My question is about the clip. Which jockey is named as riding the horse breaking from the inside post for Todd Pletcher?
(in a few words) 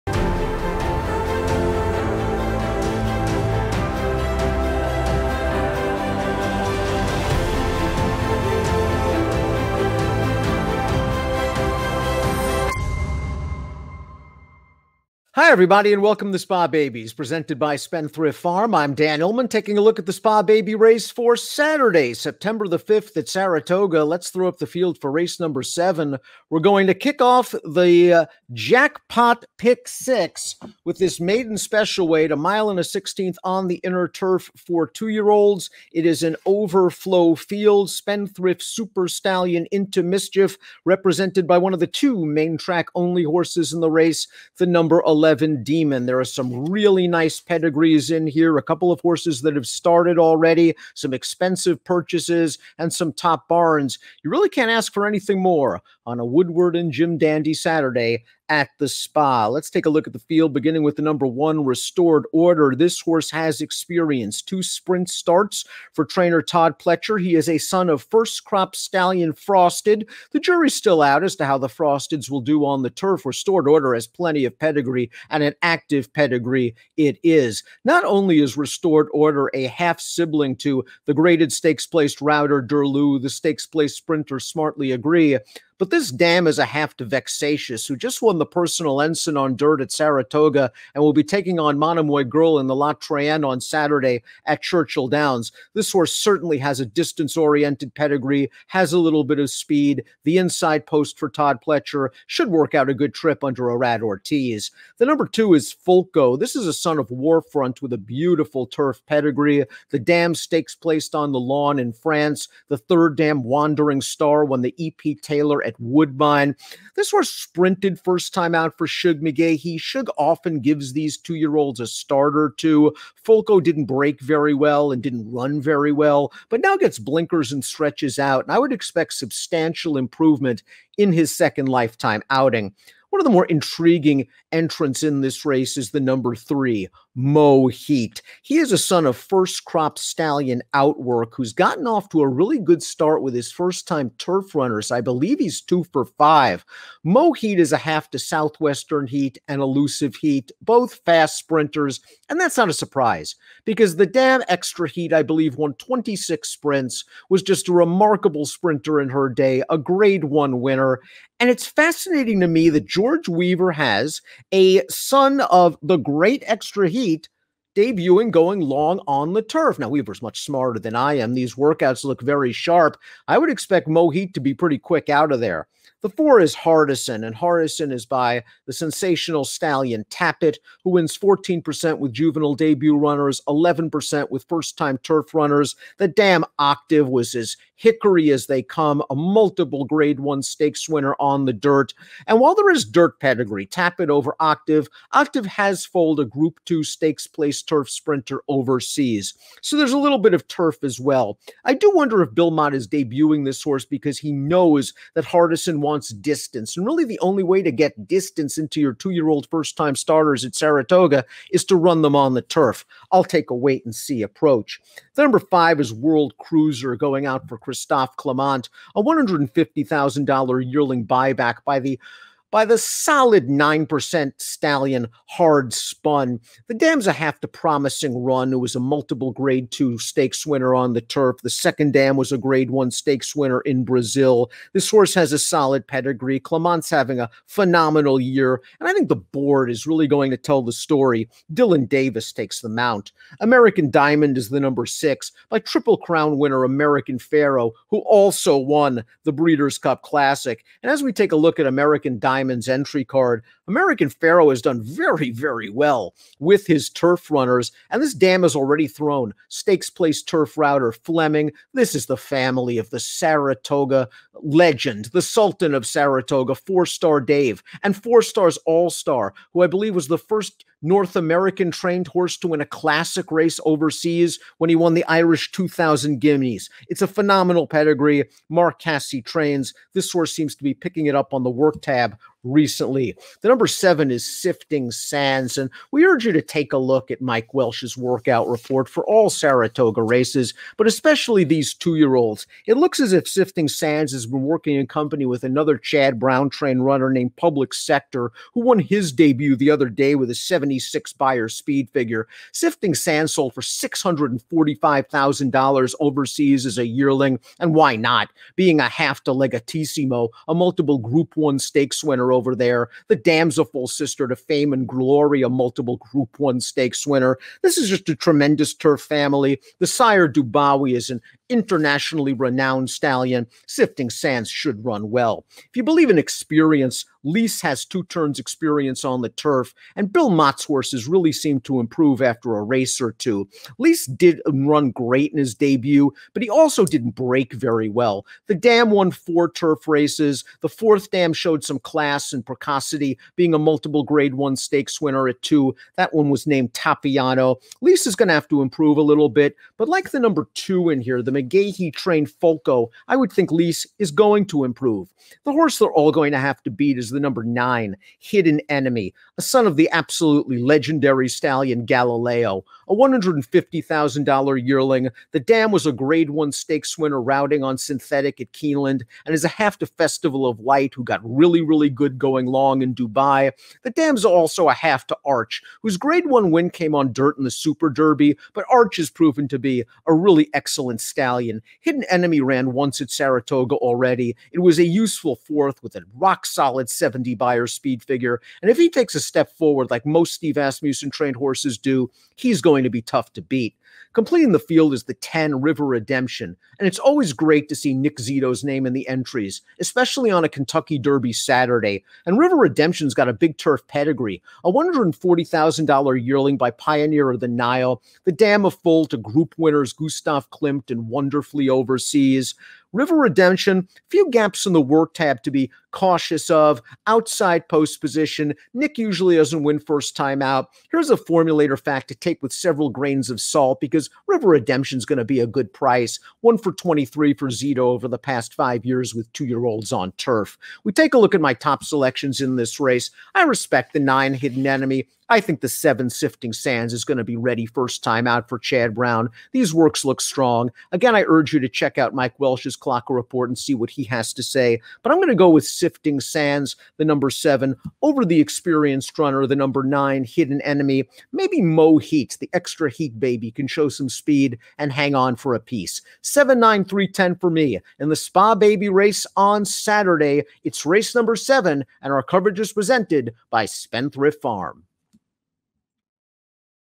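Irad Ortiz.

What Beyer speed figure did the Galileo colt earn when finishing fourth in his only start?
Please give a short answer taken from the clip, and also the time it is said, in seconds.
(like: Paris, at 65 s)
70, at 386 s.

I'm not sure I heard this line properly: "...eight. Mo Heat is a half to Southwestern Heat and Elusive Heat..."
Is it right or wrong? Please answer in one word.
wrong.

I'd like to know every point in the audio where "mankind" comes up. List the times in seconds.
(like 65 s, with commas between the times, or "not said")
not said.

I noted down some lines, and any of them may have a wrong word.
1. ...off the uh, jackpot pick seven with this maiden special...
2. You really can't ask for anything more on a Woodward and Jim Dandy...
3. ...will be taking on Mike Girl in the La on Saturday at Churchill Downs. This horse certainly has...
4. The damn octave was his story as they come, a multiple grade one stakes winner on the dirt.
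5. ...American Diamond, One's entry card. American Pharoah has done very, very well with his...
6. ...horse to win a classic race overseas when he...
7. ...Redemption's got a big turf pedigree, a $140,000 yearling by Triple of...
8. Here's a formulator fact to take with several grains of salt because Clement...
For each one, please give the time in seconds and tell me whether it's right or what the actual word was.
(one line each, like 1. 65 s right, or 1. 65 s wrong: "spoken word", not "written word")
1. 27 s wrong: "six", not "seven"
2. 54 s right
3. 91 s wrong: "Monomoy", not "Mike"
4. 185 s wrong: "hickory", not "story"
5. 251 s wrong: "Diamond", not "One"
6. 272 s right
7. 402 s wrong: "Pioneer", not "Triple"
8. 420 s wrong: "River", not "Clement".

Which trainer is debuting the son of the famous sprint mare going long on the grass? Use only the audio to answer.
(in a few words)
George Weaver.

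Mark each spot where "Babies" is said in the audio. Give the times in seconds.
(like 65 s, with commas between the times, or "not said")
16 s.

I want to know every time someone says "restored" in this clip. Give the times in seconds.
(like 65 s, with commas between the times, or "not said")
61 s, 73 s, 78 s.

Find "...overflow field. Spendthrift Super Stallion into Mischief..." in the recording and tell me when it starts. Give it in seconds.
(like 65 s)
36 s.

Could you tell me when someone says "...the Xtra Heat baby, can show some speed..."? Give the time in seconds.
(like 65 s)
452 s.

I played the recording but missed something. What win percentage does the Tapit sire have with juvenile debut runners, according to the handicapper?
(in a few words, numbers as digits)
14%.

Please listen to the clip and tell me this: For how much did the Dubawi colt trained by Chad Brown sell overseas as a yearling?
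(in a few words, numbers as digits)
$645,000.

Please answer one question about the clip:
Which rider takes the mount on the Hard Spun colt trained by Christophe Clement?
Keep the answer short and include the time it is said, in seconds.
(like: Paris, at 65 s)
Dylan Davis, at 241 s.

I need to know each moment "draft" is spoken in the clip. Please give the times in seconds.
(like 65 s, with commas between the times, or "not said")
not said.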